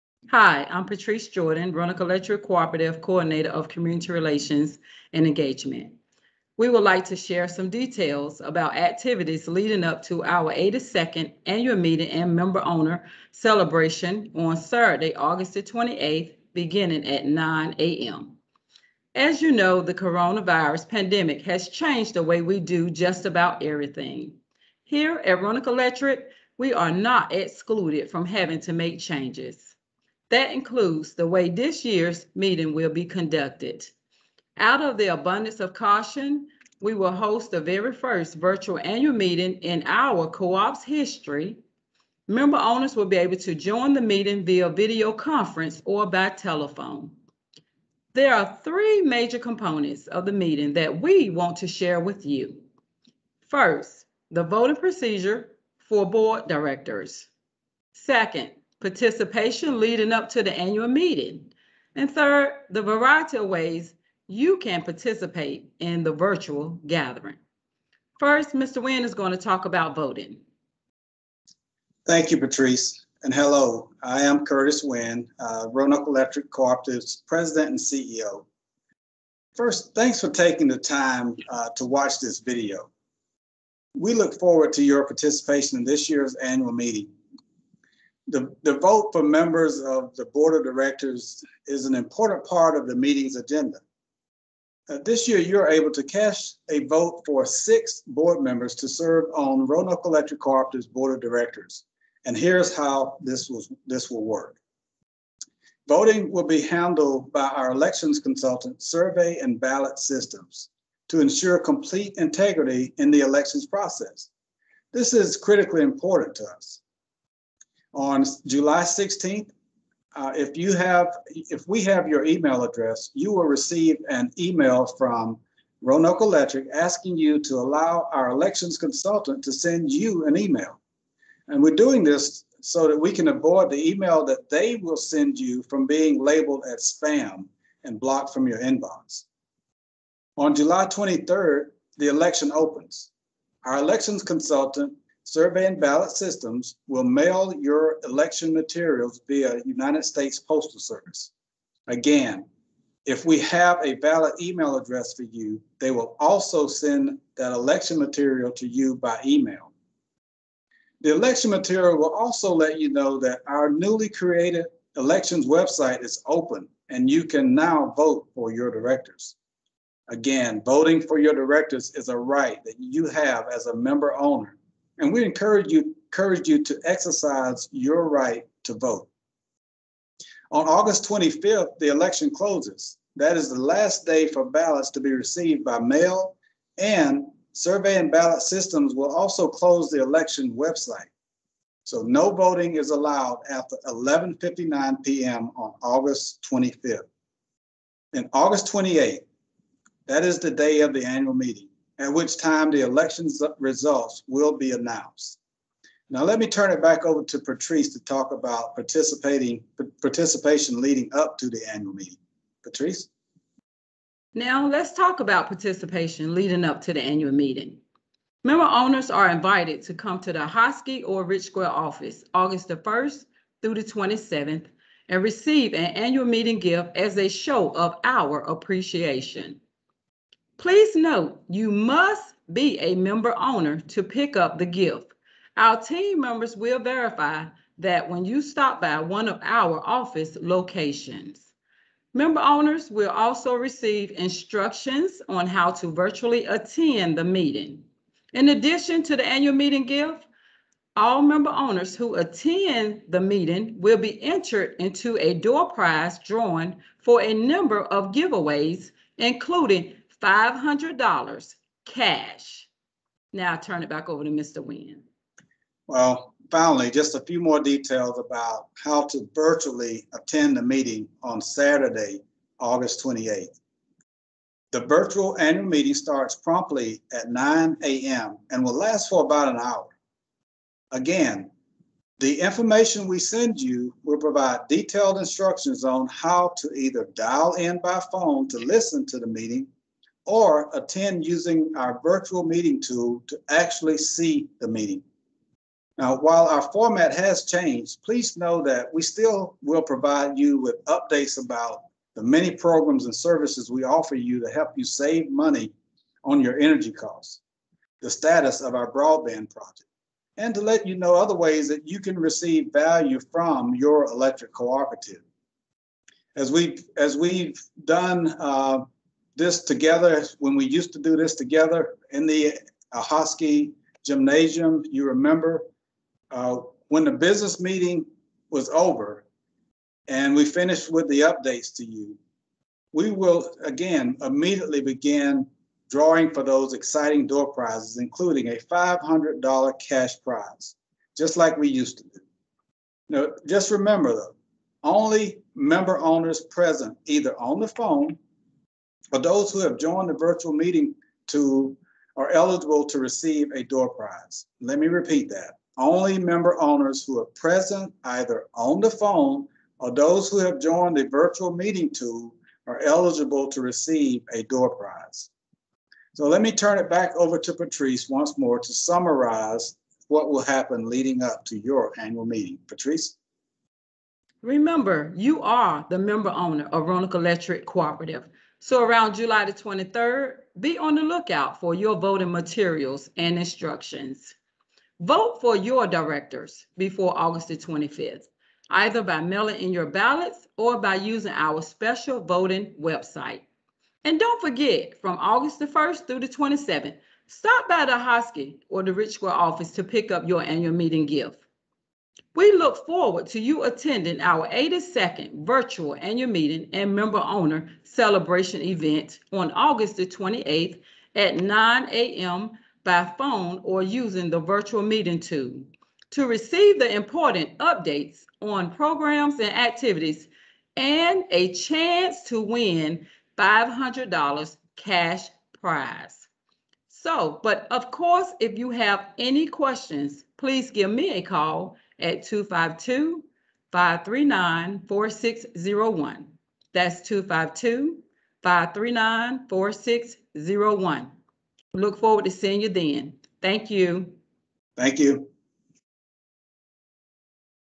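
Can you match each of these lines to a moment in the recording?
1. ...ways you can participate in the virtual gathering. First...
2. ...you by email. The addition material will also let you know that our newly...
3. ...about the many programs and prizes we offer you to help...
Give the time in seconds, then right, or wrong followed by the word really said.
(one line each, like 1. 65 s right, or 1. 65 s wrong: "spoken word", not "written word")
1. 63 s right
2. 158 s wrong: "election", not "addition"
3. 301 s wrong: "services", not "prizes".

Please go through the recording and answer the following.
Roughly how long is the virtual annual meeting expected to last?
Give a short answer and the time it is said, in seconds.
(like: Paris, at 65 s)
about an hour, at 279 s.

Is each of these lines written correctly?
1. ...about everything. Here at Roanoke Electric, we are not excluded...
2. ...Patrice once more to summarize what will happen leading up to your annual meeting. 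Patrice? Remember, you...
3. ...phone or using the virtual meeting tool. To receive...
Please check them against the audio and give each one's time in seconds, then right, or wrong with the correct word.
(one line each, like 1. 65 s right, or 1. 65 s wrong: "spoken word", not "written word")
1. 23 s right
2. 367 s right
3. 413 s right.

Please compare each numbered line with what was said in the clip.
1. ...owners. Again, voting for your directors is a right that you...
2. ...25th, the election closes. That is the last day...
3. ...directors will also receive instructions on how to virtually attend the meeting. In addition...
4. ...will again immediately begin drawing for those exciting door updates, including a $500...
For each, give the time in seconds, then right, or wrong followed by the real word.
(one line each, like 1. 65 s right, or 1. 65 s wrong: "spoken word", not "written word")
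1. 168 s wrong: "directors", not "owners"
2. 181 s right
3. 242 s wrong: "owners", not "directors"
4. 333 s wrong: "prizes", not "updates".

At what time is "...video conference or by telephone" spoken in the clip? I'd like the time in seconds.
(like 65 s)
44 s.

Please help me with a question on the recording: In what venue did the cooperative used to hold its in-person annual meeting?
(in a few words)
Ahoskie Gymnasium.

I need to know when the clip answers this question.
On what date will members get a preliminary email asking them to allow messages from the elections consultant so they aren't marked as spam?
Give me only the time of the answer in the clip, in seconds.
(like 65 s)
118 s.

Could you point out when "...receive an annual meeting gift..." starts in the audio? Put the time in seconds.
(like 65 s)
225 s.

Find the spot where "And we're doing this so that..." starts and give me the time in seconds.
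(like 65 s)
131 s.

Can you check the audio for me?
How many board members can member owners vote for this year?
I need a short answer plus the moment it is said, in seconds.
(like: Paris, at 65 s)
6, at 97 s.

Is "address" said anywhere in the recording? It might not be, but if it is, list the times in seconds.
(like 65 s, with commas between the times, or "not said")
122 s, 154 s.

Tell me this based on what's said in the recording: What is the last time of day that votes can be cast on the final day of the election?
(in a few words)
11:59 p.m.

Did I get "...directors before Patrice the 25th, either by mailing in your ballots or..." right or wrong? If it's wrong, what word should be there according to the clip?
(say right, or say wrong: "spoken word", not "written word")
wrong: "August", not "Patrice".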